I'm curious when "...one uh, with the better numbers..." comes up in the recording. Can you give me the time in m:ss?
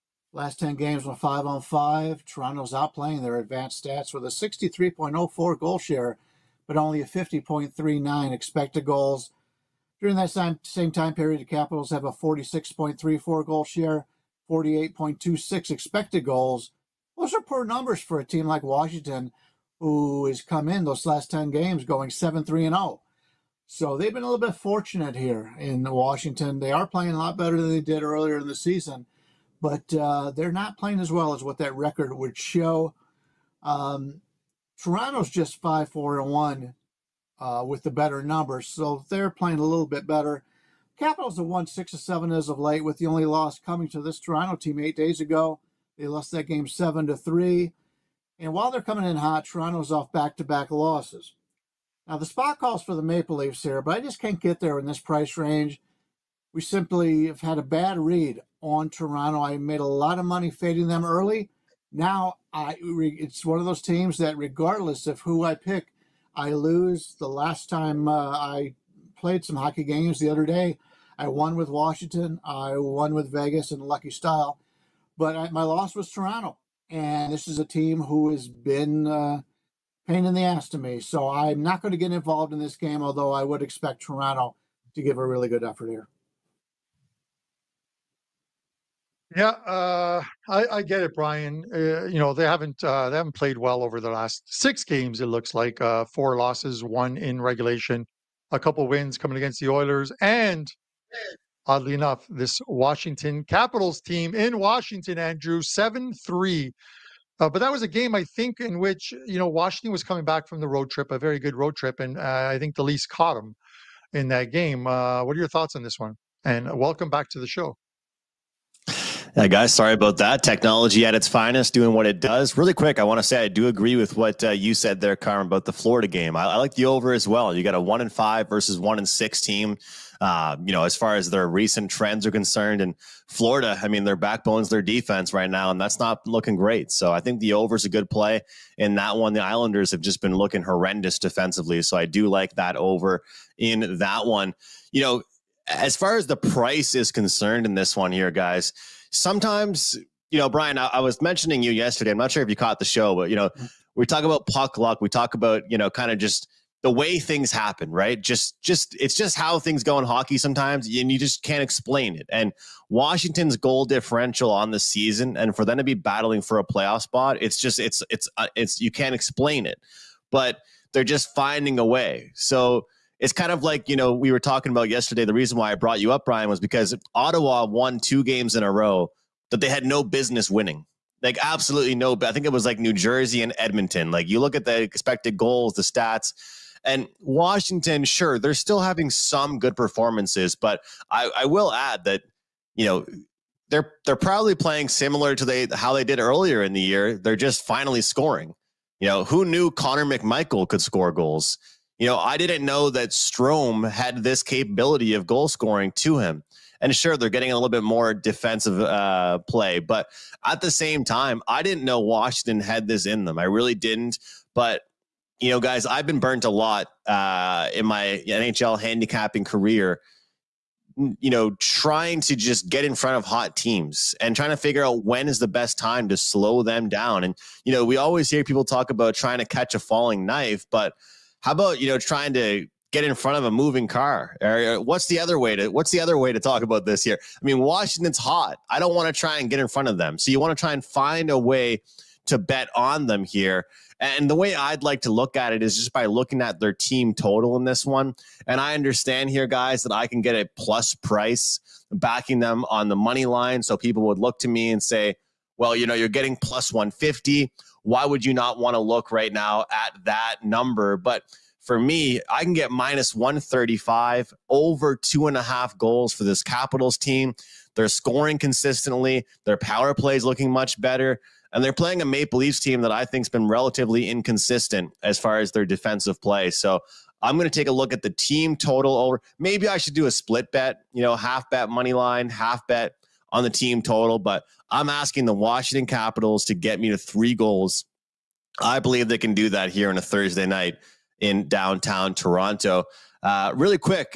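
0:36.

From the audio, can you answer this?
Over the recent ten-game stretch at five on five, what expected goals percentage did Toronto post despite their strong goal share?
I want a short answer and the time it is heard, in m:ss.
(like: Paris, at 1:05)
50.39, at 0:07.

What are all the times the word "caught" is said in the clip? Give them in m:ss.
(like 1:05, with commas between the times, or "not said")
1:53, 2:32.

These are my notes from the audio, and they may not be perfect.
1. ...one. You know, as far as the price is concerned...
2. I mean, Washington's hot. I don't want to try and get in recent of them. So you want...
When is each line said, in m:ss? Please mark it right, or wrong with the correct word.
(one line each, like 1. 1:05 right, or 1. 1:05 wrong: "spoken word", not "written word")
1. 2:24 right
2. 3:57 wrong: "front", not "recent".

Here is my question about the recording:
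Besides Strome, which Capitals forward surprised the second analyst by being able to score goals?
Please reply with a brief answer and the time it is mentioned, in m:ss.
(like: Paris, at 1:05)
Connor McMichael, at 3:19.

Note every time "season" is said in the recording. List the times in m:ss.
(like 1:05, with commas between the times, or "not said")
0:28, 2:44.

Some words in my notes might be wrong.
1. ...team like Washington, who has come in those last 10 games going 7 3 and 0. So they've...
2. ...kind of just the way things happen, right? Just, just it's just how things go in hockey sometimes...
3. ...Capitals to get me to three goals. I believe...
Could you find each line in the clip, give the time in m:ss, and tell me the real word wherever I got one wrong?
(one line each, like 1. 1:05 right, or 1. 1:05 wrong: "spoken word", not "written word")
1. 0:18 right
2. 2:35 right
3. 4:45 right.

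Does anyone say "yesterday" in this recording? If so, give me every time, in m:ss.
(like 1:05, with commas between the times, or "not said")
2:31, 2:54.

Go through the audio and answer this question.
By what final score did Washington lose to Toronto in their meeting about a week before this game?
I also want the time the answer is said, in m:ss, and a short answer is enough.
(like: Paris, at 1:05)
7-3, at 0:46.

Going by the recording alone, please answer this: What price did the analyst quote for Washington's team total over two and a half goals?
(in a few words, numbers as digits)
-135.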